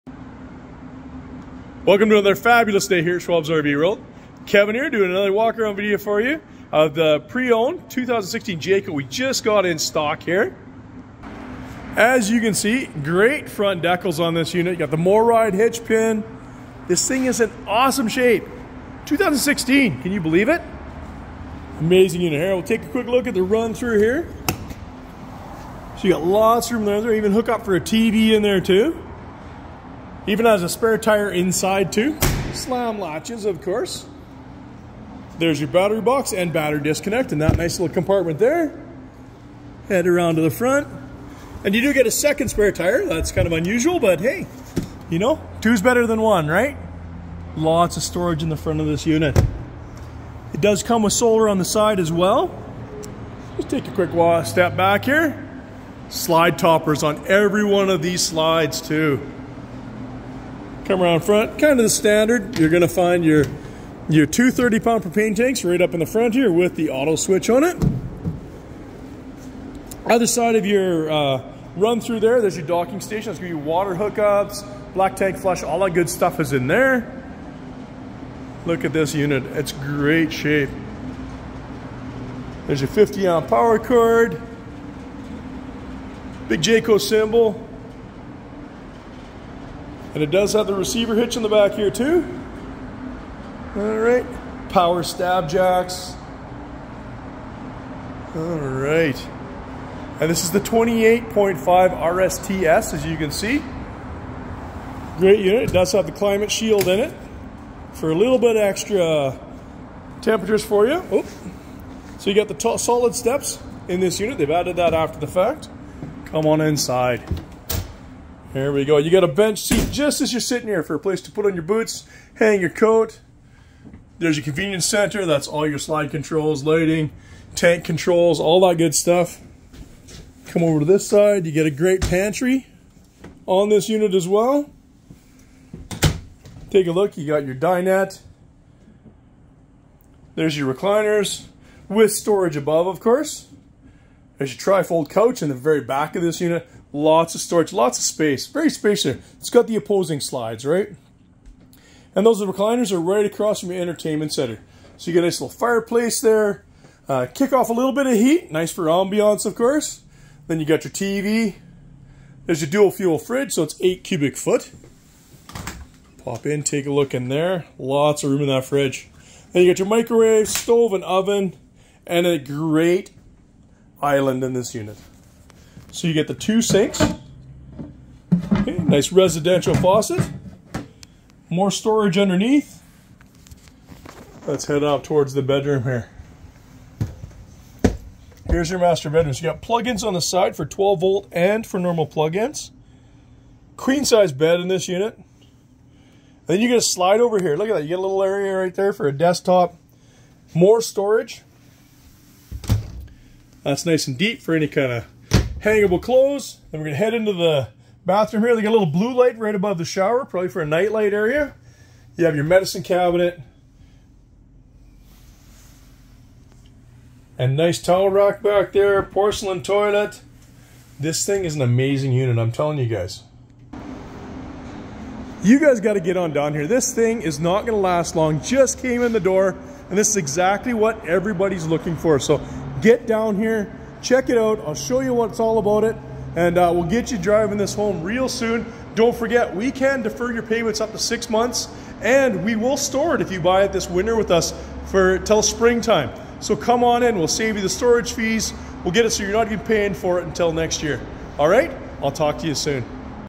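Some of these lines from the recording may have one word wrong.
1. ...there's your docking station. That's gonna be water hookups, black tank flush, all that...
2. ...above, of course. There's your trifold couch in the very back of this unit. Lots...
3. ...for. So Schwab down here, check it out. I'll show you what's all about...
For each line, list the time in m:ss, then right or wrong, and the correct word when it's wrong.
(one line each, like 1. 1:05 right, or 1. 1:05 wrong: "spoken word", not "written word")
1. 1:12 right
2. 2:22 right
3. 3:51 wrong: "Get", not "Schwab".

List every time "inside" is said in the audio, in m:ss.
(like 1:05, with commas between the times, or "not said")
0:31, 1:56.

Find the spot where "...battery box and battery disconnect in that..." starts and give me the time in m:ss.
0:35.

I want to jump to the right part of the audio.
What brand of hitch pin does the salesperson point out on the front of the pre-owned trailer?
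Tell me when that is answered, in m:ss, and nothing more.
0:14.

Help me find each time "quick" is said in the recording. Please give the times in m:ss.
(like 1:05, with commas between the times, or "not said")
0:22, 0:53.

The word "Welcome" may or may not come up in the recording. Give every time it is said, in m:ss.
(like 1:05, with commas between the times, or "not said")
0:01.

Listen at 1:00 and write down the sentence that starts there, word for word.
Come around front, kind of the standard.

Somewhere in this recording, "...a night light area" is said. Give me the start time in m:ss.
3:30.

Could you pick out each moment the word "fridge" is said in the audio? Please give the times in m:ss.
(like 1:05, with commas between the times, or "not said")
2:43, 2:48.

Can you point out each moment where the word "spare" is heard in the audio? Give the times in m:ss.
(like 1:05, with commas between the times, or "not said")
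0:30, 0:42.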